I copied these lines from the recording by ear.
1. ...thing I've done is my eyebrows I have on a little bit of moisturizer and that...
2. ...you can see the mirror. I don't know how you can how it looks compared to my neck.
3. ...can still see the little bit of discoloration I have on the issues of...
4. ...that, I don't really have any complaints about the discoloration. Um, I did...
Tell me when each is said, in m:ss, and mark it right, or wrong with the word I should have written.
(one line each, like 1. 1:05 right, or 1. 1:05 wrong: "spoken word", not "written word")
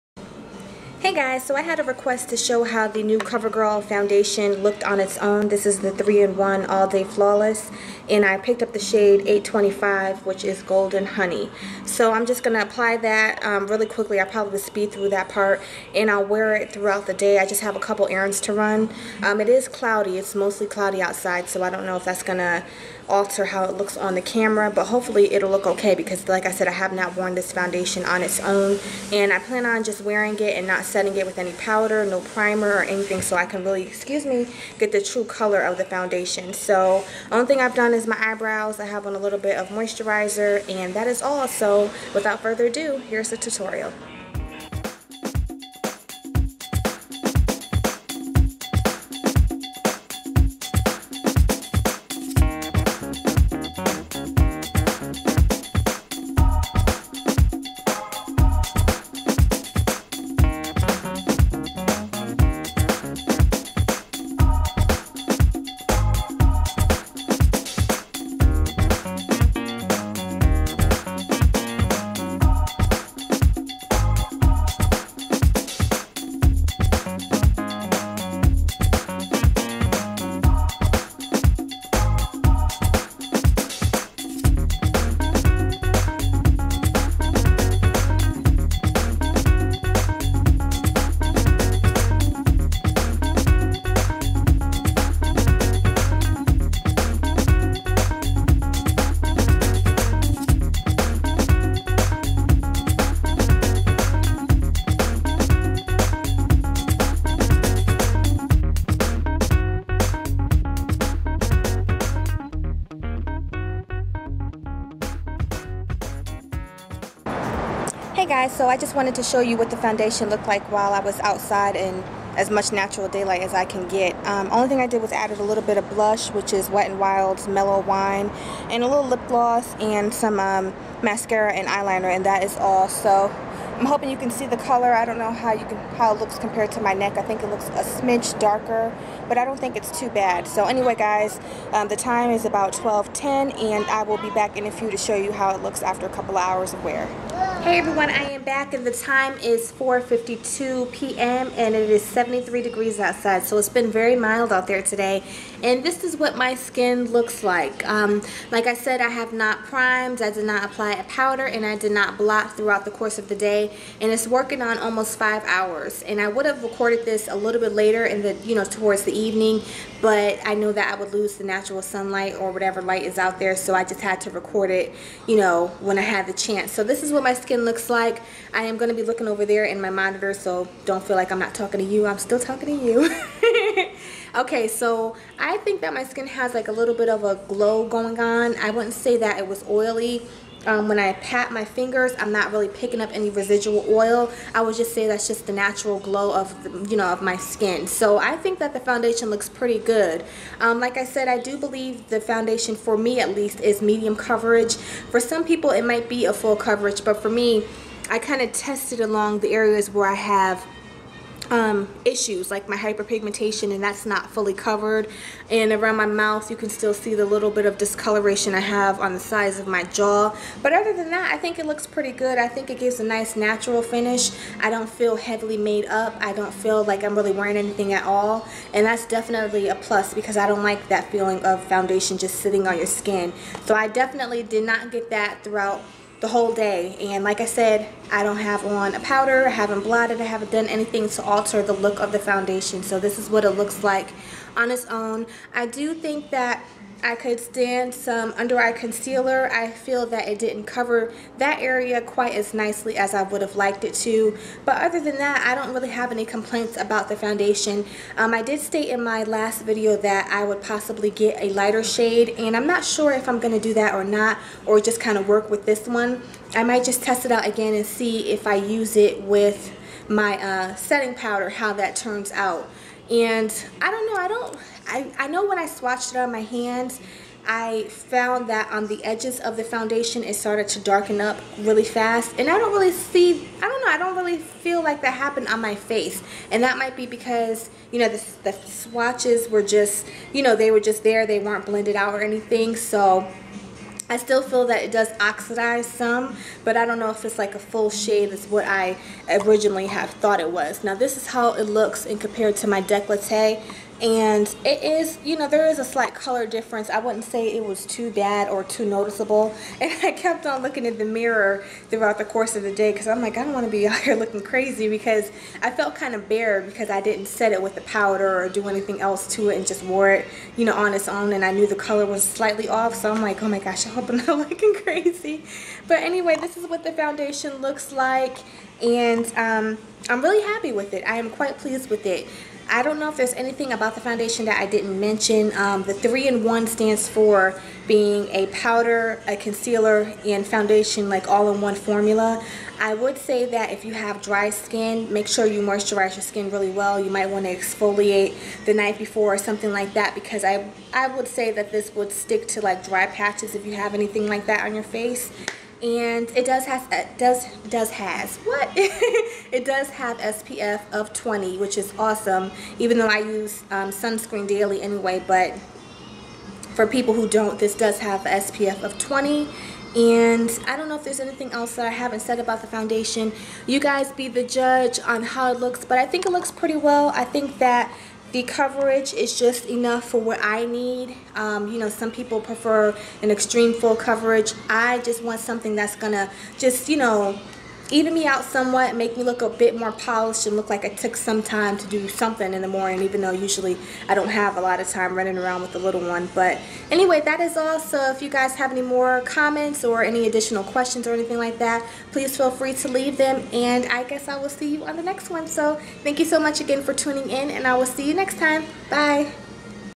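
1. 0:37 right
2. 2:14 wrong: "color", not "mirror"
3. 3:36 wrong: "sides", not "issues"
4. 4:15 wrong: "foundation", not "discoloration".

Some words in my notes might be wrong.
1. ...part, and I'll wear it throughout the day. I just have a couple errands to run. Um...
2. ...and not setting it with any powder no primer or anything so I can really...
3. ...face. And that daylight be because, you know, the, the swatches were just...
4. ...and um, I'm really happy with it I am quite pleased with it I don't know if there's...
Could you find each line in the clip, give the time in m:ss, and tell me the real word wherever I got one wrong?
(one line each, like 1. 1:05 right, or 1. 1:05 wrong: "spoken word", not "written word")
1. 0:15 right
2. 0:30 right
3. 4:45 wrong: "might", not "daylight"
4. 5:28 right.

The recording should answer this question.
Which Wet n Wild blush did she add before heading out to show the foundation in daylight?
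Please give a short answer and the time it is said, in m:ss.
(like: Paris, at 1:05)
Mellow Wine, at 2:07.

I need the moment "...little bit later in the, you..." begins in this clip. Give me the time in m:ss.
2:47.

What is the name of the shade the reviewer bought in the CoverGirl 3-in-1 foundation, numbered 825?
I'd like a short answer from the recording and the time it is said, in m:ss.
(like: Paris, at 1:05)
Golden Honey, at 0:10.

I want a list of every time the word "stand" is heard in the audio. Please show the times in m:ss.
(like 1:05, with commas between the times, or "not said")
4:07, 5:36.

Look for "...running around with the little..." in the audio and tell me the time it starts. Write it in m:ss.
6:35.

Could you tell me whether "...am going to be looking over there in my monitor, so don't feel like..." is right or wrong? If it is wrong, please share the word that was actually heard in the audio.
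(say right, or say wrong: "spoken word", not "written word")
right.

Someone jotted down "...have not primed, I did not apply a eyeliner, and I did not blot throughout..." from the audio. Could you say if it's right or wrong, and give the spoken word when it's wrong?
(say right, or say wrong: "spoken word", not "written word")
wrong: "powder", not "eyeliner".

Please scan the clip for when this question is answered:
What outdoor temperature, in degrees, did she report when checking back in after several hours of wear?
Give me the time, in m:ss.
2:32.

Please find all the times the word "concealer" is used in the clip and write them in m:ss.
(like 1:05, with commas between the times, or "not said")
4:08, 5:39.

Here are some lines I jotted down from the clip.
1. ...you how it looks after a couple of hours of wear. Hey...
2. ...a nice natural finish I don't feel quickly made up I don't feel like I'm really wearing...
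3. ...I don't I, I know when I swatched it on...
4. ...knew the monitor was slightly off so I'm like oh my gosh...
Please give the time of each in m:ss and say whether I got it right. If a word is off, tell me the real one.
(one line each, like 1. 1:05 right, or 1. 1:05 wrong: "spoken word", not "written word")
1. 2:25 right
2. 3:43 wrong: "heavily", not "quickly"
3. 4:34 right
4. 5:21 wrong: "color", not "monitor".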